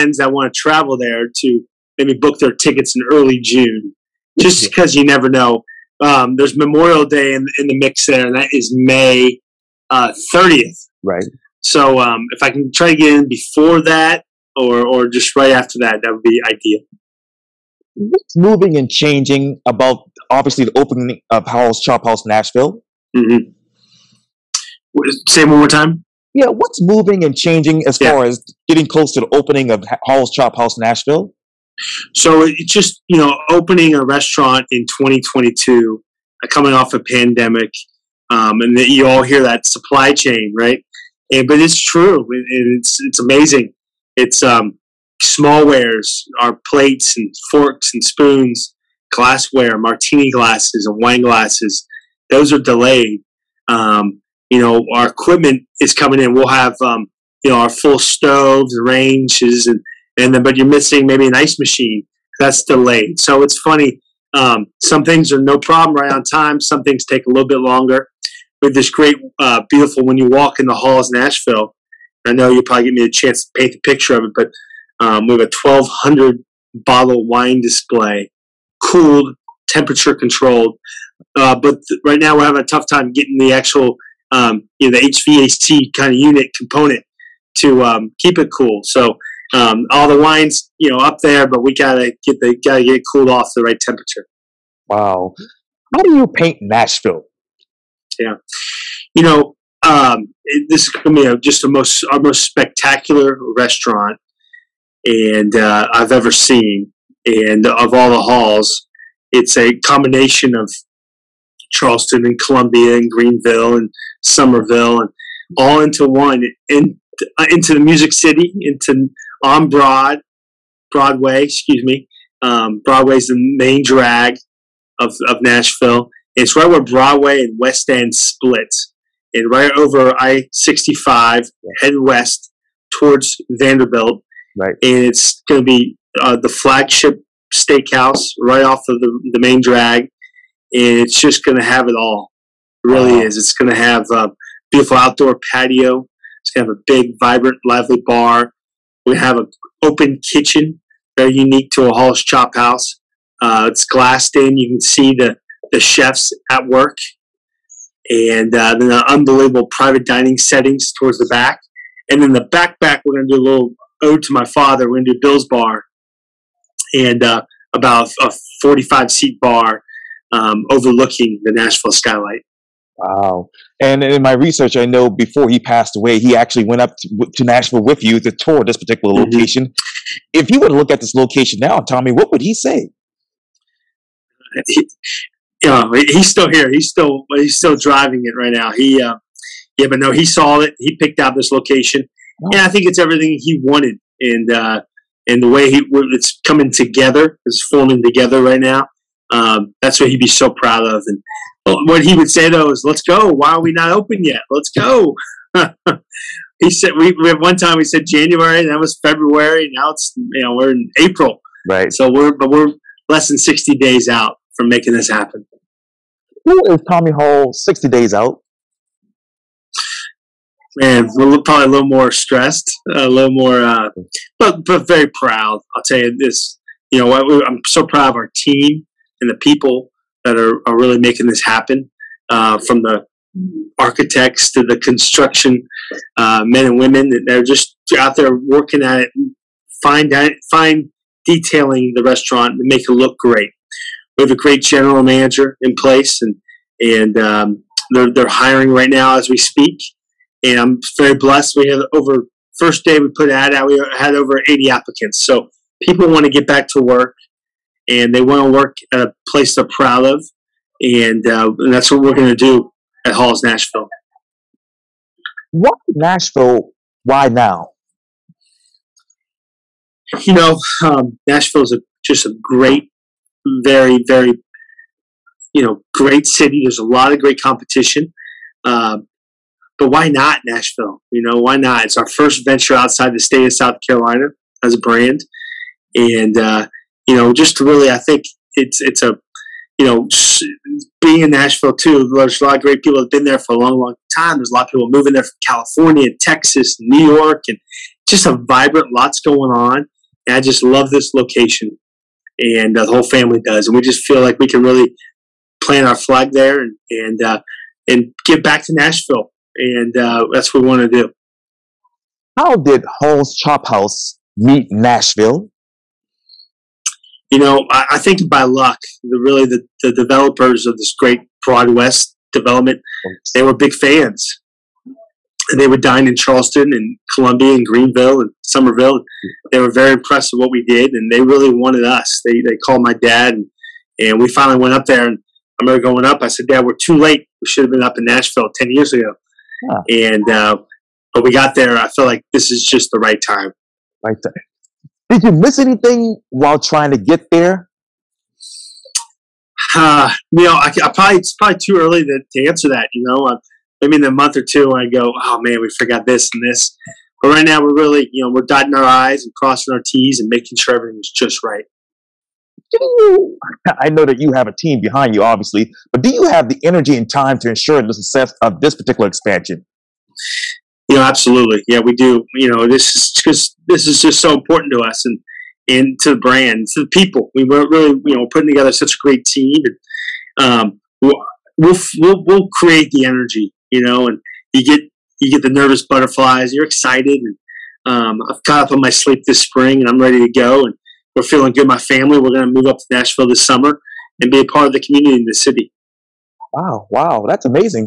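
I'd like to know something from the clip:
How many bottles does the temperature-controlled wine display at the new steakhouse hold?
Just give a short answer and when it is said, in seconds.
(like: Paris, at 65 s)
1200, at 75 s.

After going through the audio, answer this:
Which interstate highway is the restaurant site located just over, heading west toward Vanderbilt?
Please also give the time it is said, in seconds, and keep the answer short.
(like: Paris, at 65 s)
I 65, at 130 s.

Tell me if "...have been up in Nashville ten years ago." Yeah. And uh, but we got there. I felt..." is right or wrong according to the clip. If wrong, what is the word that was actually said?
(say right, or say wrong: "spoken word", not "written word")
right.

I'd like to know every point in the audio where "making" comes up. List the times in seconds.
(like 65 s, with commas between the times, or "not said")
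214 s, 230 s, 360 s.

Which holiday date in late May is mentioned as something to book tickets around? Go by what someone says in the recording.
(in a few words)
May 30th.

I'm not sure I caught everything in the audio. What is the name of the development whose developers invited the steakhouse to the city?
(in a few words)
Broad West.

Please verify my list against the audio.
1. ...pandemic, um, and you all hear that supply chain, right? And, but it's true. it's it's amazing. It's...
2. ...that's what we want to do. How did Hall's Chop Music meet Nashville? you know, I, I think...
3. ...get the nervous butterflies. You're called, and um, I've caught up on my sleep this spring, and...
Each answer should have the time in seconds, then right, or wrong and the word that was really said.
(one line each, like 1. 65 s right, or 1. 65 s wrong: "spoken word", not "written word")
1. 37 s right
2. 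310 s wrong: "House", not "Music"
3. 385 s wrong: "excited", not "called".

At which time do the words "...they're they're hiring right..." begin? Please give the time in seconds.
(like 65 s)
247 s.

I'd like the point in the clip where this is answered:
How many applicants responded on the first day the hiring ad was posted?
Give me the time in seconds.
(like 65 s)
254 s.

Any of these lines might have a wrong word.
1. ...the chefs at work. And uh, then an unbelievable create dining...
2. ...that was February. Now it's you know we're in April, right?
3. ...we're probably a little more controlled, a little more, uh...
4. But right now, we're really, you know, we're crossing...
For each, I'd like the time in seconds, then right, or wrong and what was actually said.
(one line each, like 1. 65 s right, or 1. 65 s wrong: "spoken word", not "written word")
1. 155 s wrong: "private", not "create"
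2. 208 s right
3. 221 s wrong: "stressed", not "controlled"
4. 357 s wrong: "dotting", not "crossing".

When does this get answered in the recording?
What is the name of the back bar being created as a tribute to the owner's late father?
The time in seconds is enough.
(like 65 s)
165 s.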